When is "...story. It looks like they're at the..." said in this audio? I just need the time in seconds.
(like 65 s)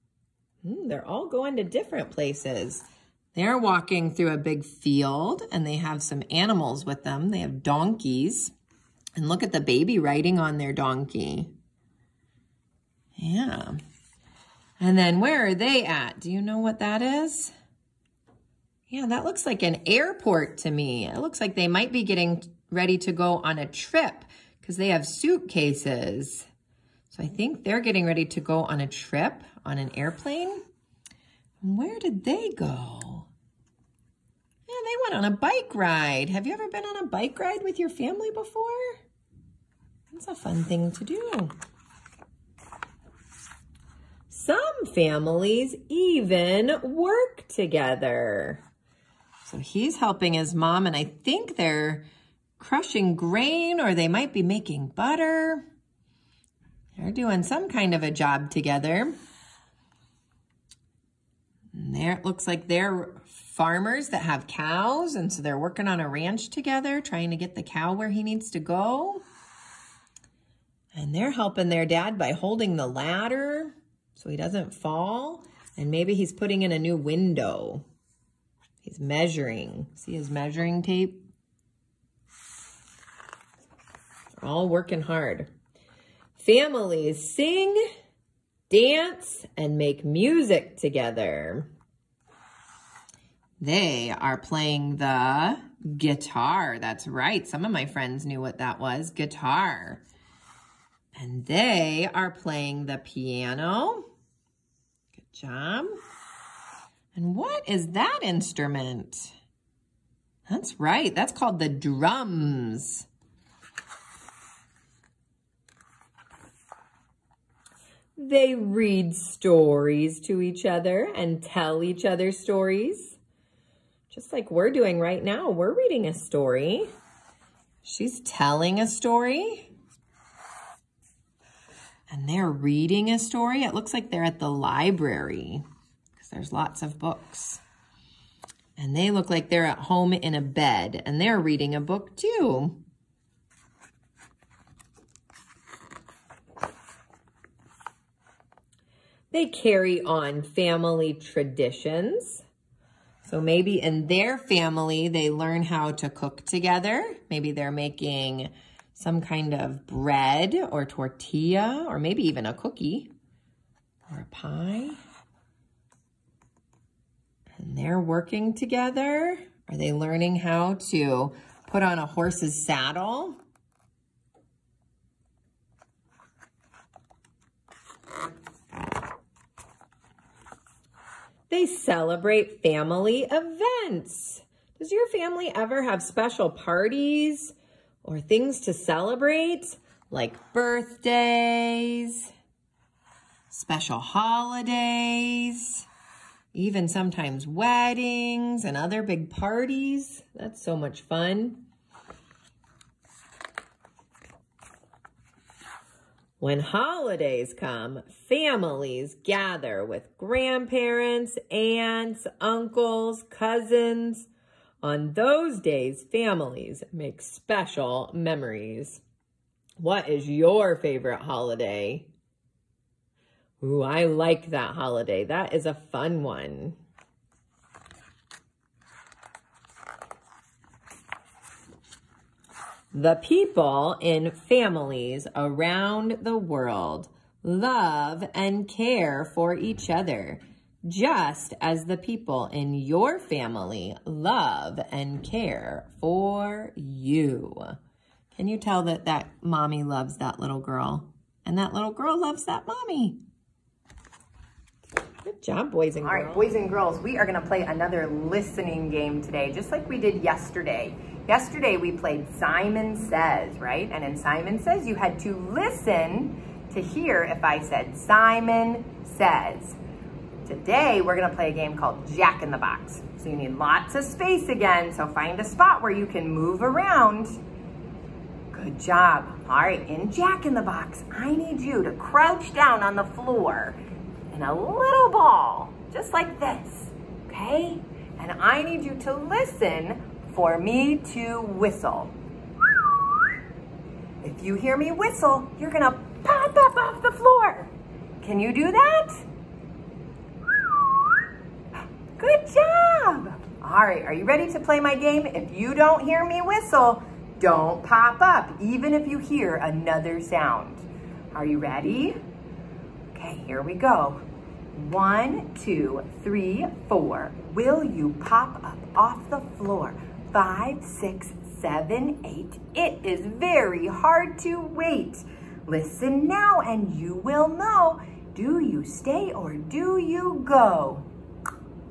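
133 s.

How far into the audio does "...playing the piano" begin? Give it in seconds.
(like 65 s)
102 s.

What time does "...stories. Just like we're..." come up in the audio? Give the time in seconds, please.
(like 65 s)
122 s.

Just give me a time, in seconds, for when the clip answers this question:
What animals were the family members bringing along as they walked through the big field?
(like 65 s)
7 s.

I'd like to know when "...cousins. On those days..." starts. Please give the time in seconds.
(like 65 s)
213 s.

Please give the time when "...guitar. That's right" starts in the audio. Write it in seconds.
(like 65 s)
95 s.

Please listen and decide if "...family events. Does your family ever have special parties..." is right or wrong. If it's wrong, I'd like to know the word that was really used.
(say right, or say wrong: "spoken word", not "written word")
right.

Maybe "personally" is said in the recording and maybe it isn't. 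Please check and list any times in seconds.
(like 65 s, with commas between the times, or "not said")
not said.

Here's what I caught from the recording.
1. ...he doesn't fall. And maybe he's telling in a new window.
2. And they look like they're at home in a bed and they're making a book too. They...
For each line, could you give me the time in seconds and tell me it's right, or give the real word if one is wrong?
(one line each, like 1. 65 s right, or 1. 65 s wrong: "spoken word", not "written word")
1. 74 s wrong: "putting", not "telling"
2. 138 s wrong: "reading", not "making".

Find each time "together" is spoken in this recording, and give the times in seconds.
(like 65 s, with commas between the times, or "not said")
47 s, 58 s, 66 s, 90 s, 156 s, 168 s.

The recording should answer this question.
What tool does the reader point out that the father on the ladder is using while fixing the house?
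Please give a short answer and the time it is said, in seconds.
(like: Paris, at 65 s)
Measuring tape, at 80 s.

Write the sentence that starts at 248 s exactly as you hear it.
Can you tell that that mommy loves that little girl?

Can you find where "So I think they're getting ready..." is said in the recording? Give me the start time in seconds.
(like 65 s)
27 s.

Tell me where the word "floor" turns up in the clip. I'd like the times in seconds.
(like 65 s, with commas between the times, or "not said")
283 s, 297 s, 319 s.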